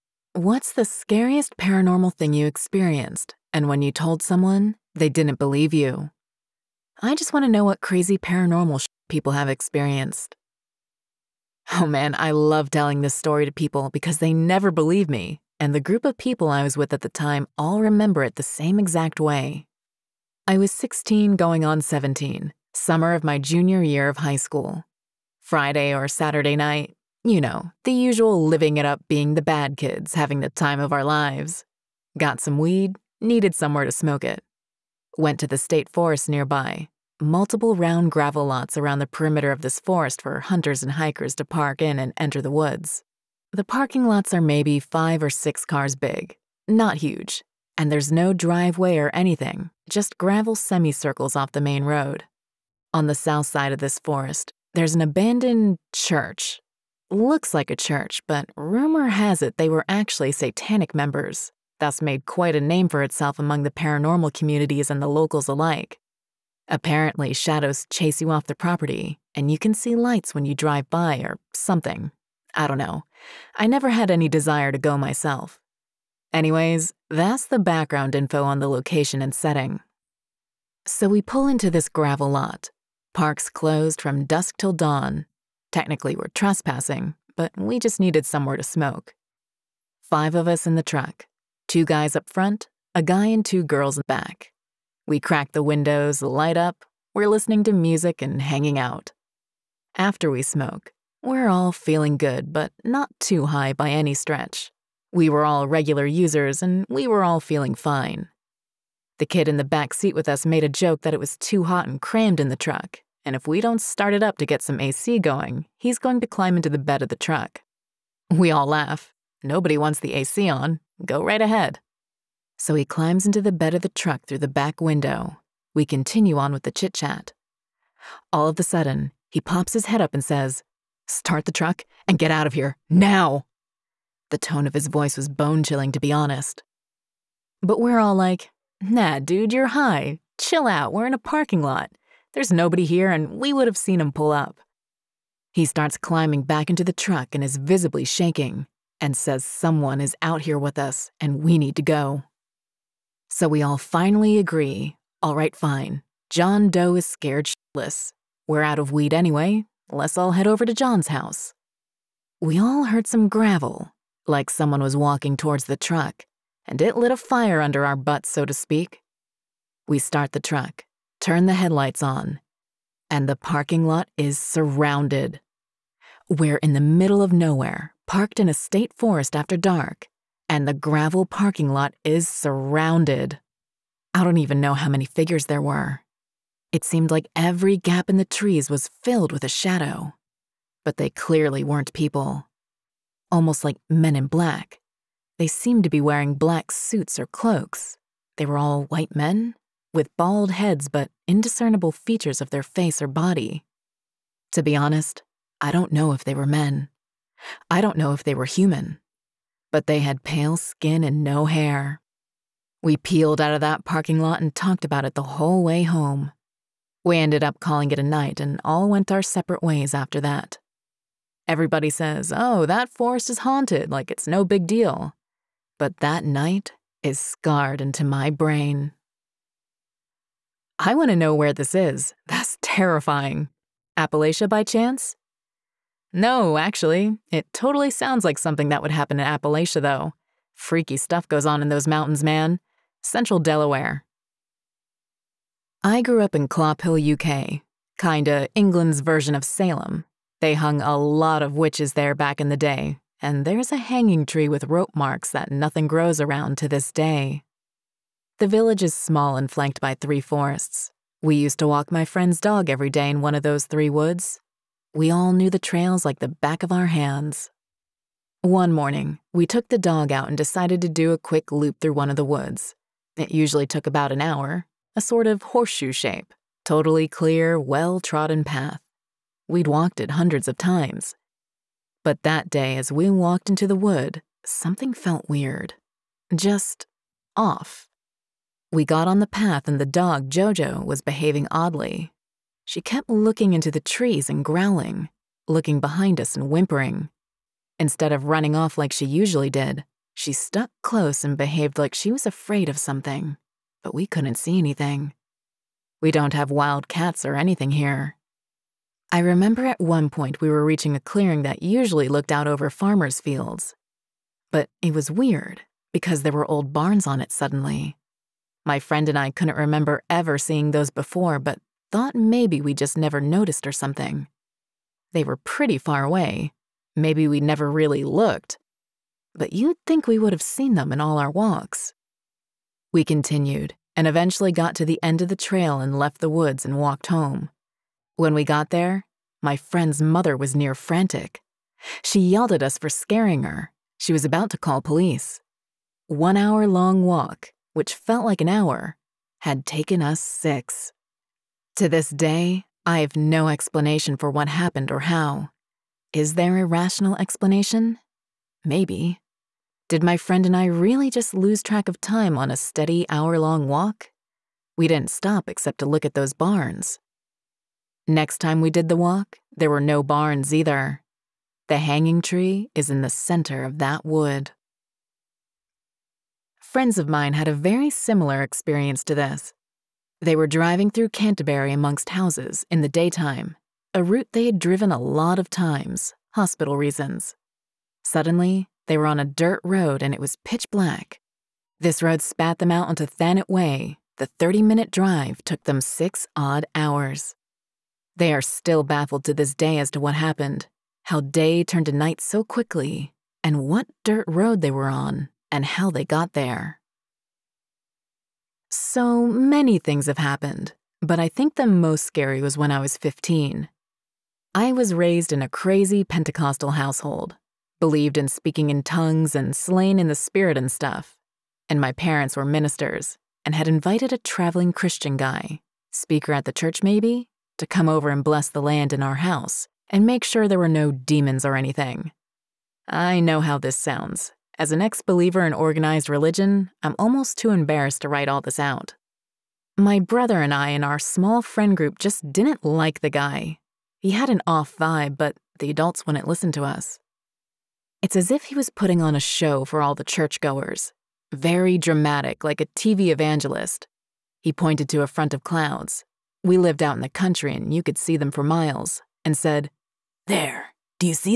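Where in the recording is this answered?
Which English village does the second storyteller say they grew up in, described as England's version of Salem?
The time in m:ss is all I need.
4:06.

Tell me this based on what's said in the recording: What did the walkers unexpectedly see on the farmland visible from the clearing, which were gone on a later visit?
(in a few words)
Old barns.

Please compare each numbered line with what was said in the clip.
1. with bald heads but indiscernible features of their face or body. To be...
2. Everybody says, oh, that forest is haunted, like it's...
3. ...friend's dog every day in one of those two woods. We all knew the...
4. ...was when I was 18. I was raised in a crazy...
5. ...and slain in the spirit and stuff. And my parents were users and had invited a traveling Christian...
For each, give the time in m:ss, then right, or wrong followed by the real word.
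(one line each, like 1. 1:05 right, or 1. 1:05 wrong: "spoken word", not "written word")
1. 3:19 right
2. 3:41 right
3. 4:22 wrong: "three", not "two"
4. 6:52 wrong: "15", not "18"
5. 6:59 wrong: "ministers", not "users".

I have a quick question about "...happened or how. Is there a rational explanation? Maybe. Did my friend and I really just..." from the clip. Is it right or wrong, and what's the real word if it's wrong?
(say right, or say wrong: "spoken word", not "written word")
right.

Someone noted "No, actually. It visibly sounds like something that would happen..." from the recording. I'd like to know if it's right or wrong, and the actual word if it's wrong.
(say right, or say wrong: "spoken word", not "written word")
wrong: "totally", not "visibly".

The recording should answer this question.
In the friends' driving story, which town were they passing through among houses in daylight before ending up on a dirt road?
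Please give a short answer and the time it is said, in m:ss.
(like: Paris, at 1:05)
Canterbury, at 6:21.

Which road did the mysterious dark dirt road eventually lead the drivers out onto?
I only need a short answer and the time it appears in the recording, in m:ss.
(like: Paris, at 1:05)
Thanet Way, at 6:33.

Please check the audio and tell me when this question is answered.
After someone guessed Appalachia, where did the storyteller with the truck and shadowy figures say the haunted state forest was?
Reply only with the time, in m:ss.
4:03.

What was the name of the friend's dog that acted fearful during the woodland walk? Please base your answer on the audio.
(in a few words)
Jojo.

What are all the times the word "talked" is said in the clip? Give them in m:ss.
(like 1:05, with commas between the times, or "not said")
3:34.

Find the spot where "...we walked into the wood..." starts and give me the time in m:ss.
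4:42.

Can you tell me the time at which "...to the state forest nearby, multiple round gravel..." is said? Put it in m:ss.
0:35.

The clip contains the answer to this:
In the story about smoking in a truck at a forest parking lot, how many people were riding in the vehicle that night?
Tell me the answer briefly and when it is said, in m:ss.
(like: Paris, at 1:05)
5, at 1:30.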